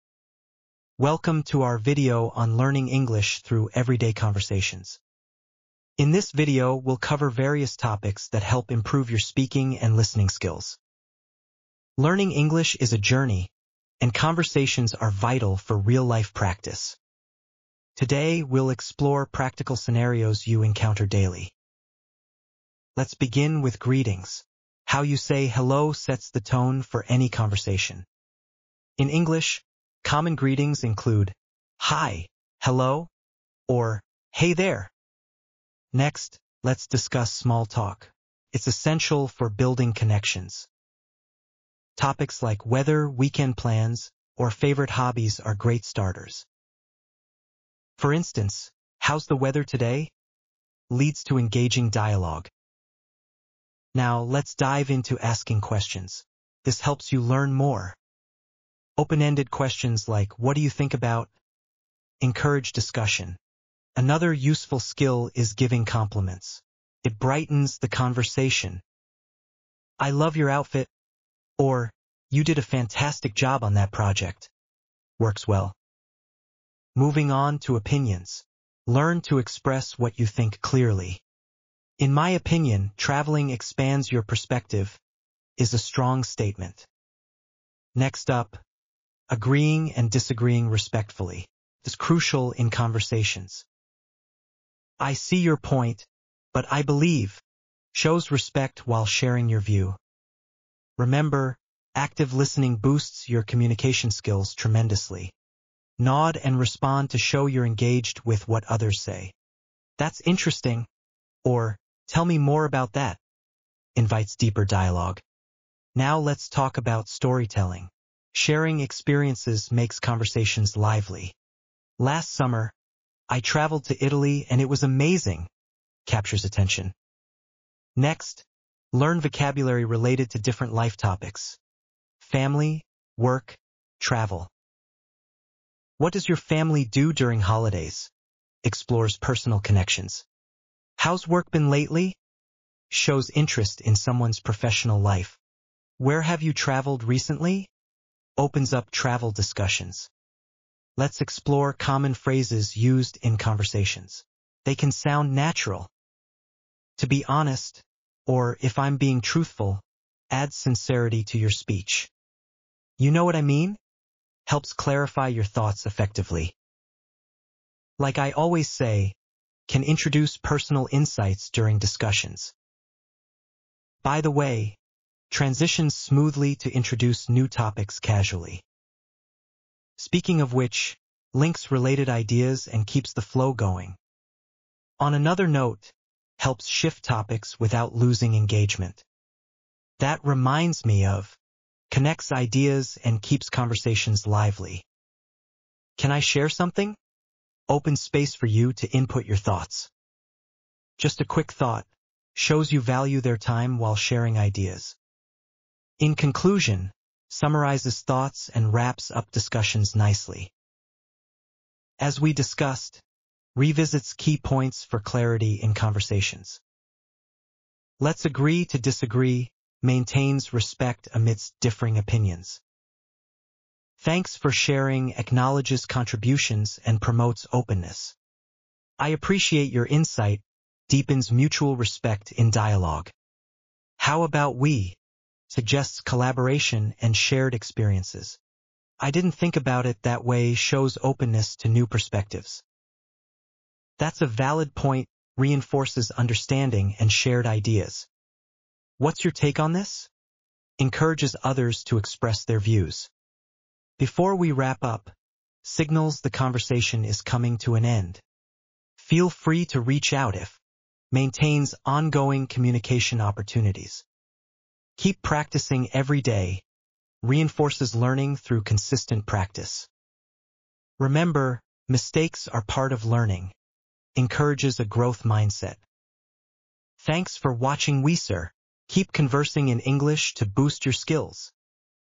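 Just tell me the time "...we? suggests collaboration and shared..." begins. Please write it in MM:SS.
03:54.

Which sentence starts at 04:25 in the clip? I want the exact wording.
Keep practicing every day reinforces learning through consistent practice.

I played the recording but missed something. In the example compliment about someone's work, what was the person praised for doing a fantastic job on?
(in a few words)
that project.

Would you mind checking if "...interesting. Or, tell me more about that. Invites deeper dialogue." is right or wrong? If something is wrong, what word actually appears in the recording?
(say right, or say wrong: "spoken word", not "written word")
right.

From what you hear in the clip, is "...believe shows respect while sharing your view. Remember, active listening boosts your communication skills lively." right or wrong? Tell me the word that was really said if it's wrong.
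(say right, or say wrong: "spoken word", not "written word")
wrong: "tremendously", not "lively".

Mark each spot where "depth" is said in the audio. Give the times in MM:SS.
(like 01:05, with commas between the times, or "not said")
not said.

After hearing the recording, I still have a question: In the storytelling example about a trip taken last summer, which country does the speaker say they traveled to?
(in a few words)
Italy.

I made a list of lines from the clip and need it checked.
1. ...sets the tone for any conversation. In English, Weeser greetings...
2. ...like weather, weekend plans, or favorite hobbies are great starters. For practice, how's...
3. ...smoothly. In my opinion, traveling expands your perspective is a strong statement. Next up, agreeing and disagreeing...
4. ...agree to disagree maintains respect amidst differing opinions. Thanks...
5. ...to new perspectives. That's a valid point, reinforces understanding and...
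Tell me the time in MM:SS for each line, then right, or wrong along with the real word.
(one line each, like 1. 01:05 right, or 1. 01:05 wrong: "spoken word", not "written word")
1. 00:25 wrong: "Common", not "Weeser"
2. 00:42 wrong: "instance", not "practice"
3. 01:20 wrong: "clearly", not "smoothly"
4. 03:38 right
5. 04:01 right.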